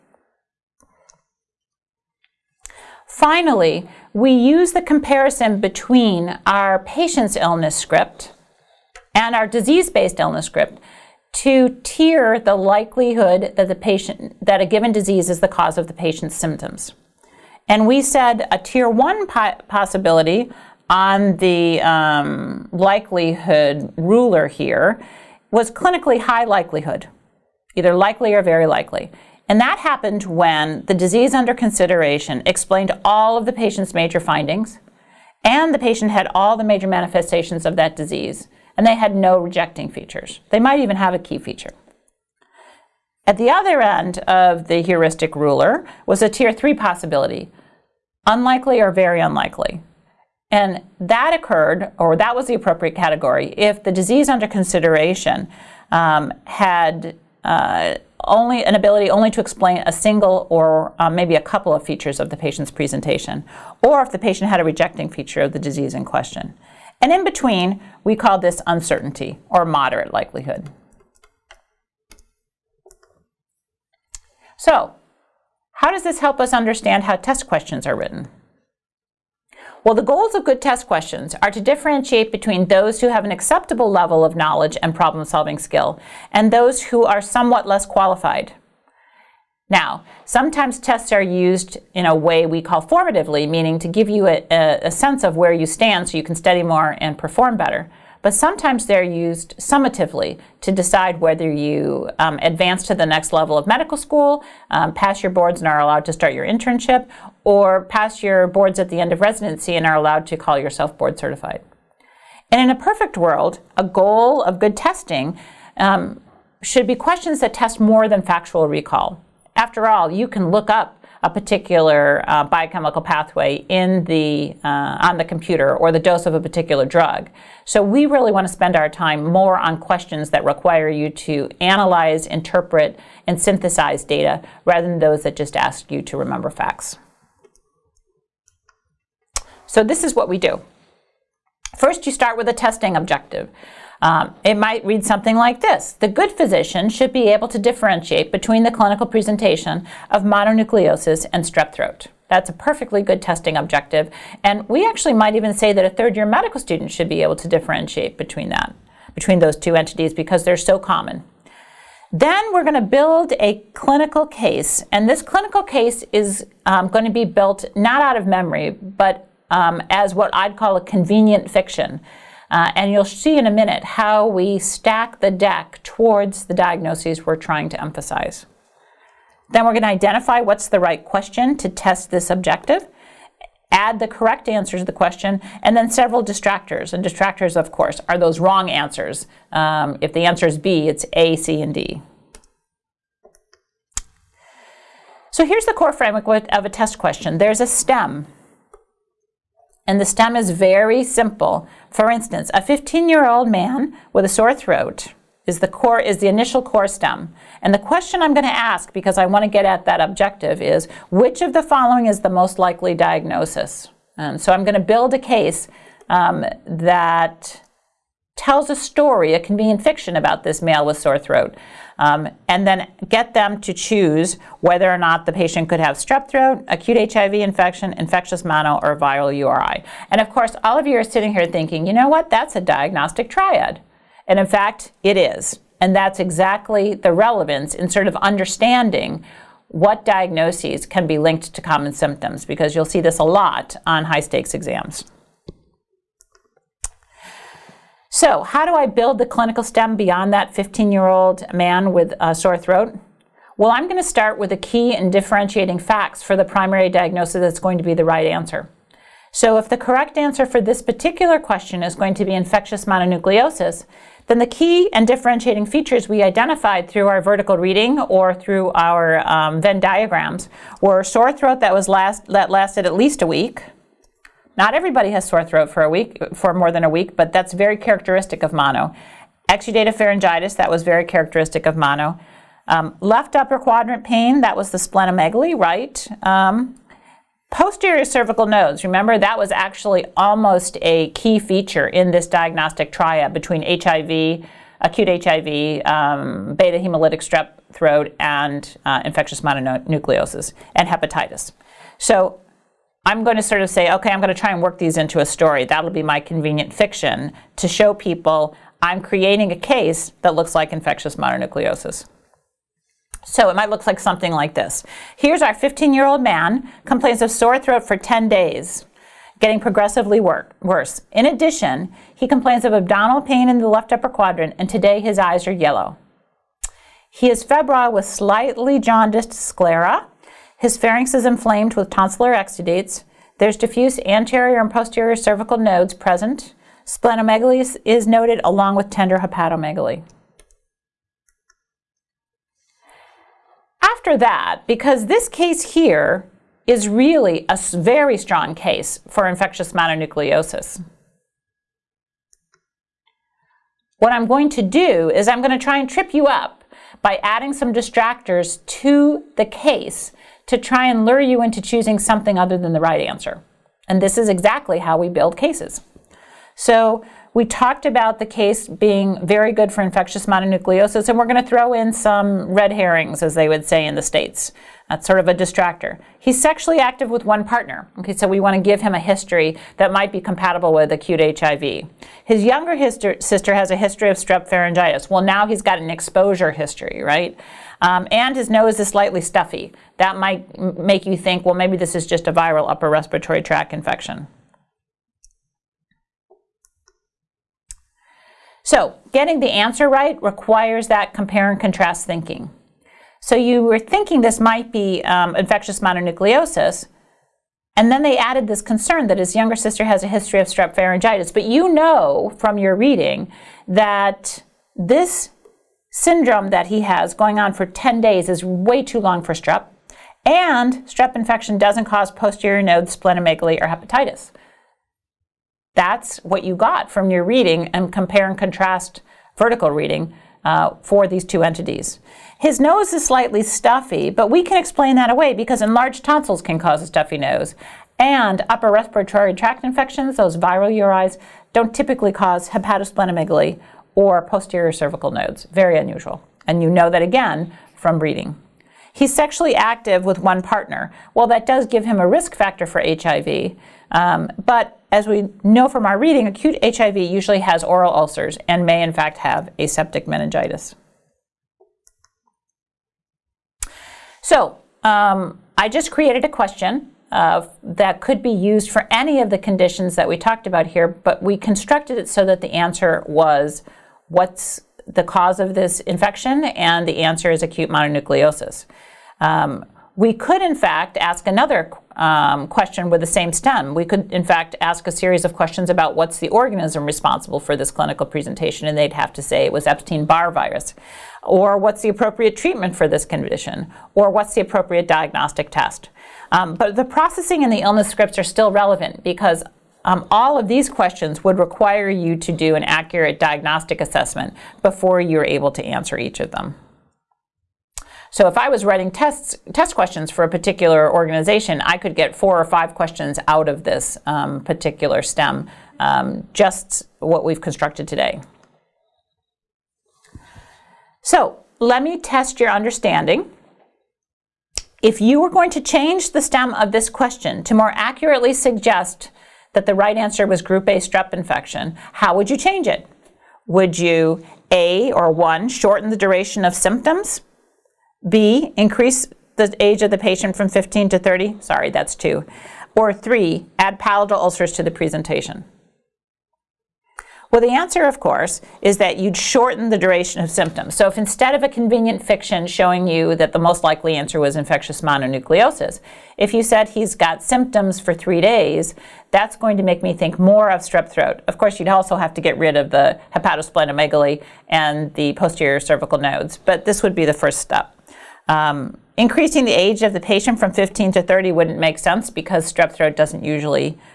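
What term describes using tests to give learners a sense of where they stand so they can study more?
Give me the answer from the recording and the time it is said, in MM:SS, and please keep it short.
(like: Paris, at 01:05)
formatively, at 01:32.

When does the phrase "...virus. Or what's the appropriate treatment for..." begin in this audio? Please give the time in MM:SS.
08:10.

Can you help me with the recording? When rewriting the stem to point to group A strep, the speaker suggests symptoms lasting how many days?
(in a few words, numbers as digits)
3.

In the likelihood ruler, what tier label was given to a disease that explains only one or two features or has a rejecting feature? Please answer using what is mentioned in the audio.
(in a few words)
tier three.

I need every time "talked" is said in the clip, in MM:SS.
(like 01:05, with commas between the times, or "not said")
06:07, 07:50.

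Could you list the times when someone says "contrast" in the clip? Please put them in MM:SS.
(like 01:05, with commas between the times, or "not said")
06:41, 07:08.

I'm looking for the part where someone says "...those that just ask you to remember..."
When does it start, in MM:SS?
02:14.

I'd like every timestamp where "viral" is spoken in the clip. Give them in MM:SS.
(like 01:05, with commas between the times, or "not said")
03:48, 06:32, 07:20.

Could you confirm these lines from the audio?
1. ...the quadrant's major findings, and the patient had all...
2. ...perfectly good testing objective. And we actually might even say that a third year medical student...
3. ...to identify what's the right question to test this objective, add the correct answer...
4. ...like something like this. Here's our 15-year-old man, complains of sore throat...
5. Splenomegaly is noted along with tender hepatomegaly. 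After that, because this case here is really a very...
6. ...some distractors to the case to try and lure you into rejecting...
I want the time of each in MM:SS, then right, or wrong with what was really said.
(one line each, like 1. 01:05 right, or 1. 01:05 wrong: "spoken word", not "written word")
1. 00:33 wrong: "patient", not "quadrant"
2. 02:32 right
3. 02:59 right
4. 05:13 right
5. 05:36 right
6. 05:57 wrong: "choosing", not "rejecting".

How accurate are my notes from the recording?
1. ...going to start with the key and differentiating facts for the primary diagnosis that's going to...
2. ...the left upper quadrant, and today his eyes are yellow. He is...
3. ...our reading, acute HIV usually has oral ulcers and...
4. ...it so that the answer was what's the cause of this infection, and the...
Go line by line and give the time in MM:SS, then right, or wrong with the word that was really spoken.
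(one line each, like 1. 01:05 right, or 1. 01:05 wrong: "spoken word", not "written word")
1. 04:13 right
2. 05:23 right
3. 07:35 right
4. 07:51 right.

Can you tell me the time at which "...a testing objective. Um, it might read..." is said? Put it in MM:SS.
02:22.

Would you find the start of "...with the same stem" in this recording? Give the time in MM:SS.
08:02.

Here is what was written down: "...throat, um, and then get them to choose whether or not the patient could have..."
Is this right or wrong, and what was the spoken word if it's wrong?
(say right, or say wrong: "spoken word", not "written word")
right.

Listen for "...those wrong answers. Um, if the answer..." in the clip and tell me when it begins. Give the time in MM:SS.
03:08.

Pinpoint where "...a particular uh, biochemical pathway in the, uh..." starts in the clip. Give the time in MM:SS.
02:01.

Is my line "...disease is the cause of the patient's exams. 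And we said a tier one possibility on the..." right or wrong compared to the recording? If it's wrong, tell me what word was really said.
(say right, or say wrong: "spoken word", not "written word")
wrong: "symptoms", not "exams".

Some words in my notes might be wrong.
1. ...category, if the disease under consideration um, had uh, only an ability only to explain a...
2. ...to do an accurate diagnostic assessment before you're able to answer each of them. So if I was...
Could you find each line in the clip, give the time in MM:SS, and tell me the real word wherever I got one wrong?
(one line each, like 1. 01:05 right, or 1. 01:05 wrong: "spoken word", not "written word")
1. 00:52 right
2. 08:22 right.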